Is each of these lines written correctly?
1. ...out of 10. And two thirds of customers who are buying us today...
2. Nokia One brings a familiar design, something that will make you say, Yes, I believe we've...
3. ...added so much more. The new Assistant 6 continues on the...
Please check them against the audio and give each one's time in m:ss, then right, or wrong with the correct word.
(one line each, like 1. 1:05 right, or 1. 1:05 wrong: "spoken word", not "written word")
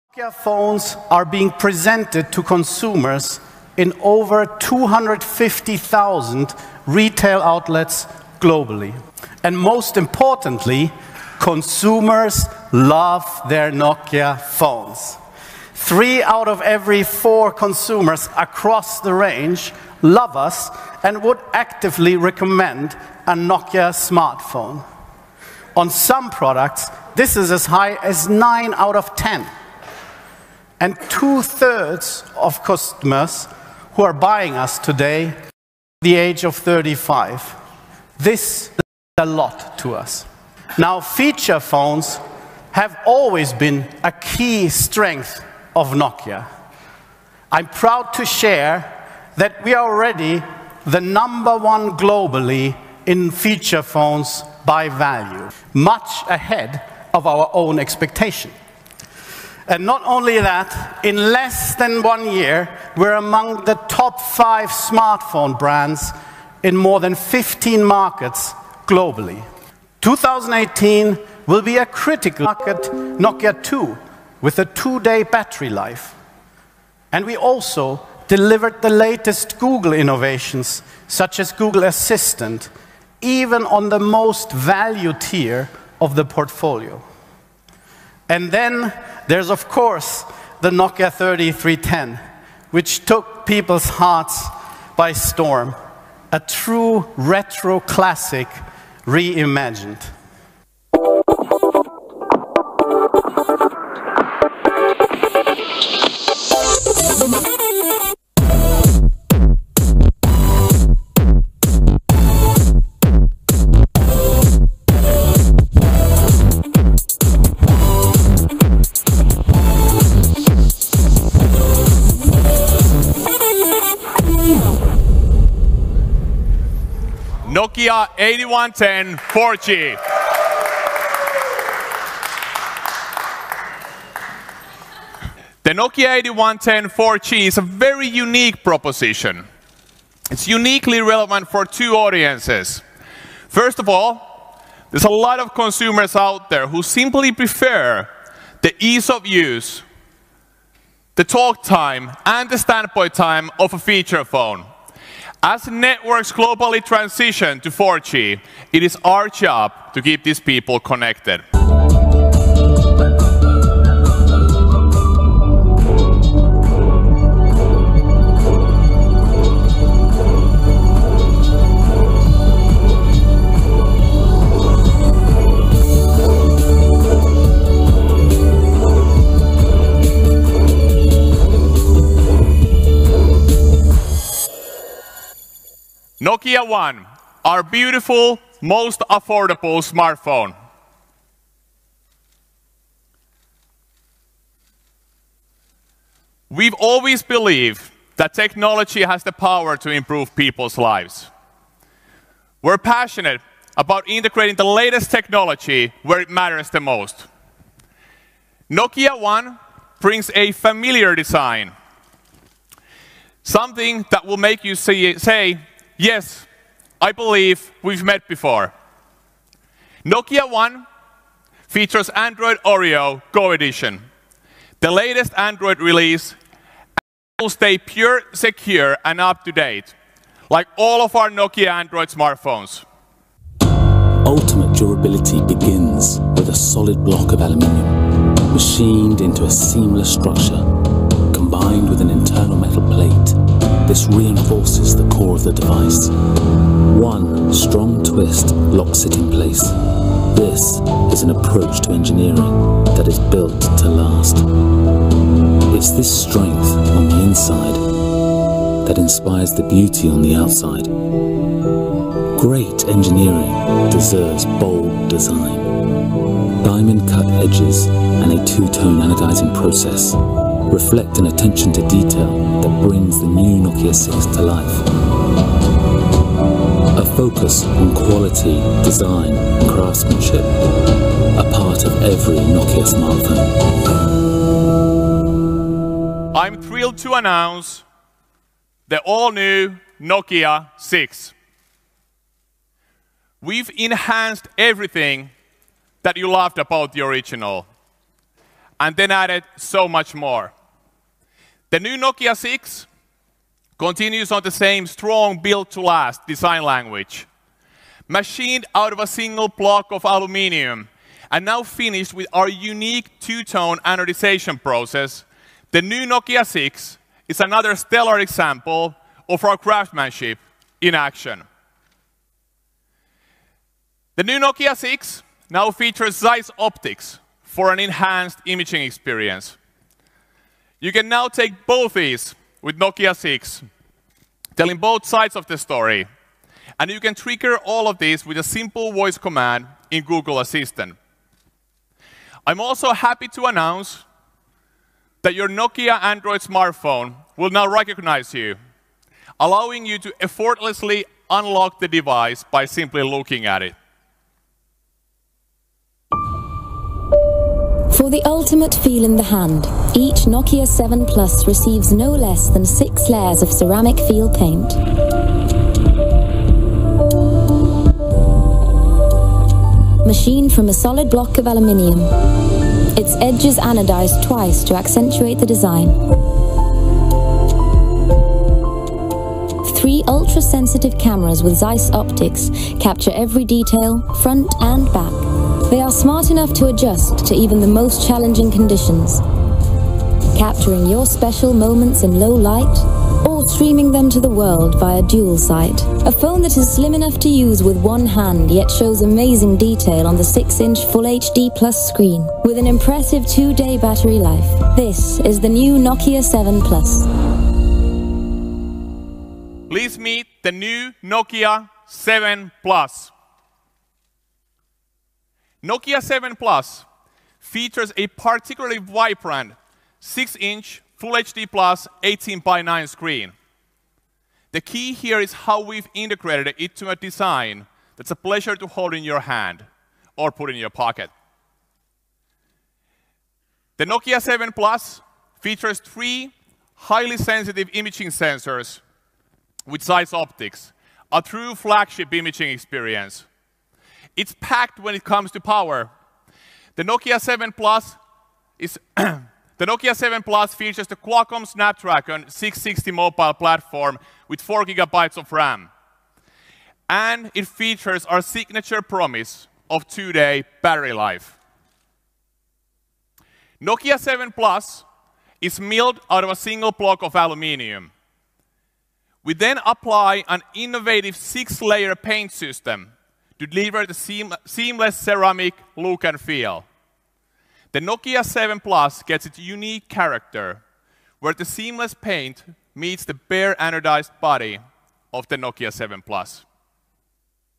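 1. 0:28 right
2. 3:28 right
3. 4:59 wrong: "Nokia", not "Assistant".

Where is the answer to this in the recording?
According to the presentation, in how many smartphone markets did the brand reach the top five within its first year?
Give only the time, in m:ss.
1:06.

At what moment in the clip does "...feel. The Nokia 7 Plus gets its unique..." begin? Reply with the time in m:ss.
7:56.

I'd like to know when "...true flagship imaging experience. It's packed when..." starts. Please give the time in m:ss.
7:21.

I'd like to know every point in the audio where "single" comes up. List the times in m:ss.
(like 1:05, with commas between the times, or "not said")
5:09, 7:46.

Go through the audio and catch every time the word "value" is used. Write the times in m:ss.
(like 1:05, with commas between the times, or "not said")
0:54, 1:24.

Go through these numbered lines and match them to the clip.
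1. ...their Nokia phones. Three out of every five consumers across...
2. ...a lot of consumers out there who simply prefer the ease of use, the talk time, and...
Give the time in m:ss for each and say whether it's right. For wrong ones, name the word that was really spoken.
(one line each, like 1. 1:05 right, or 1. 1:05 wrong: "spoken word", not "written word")
1. 0:13 wrong: "four", not "five"
2. 2:25 right.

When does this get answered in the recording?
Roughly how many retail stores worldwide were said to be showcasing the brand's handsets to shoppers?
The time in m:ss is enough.
0:04.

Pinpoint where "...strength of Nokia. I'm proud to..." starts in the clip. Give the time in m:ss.
0:44.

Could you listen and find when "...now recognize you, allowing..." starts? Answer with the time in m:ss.
5:47.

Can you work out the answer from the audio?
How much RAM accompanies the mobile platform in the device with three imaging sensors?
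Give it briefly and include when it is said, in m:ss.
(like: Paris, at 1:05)
4 gigabytes, at 7:34.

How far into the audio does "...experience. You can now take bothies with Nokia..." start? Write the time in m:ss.
5:28.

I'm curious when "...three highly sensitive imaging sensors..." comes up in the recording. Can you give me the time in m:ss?
7:15.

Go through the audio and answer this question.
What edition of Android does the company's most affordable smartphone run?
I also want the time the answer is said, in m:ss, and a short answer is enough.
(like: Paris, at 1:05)
Android Oreo Go Edition, at 3:42.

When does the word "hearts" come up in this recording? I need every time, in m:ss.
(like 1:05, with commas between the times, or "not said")
1:33.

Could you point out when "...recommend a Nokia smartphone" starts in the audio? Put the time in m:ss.
0:22.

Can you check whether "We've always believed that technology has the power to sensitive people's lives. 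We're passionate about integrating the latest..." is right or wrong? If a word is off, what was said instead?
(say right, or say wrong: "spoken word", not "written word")
wrong: "improve", not "sensitive".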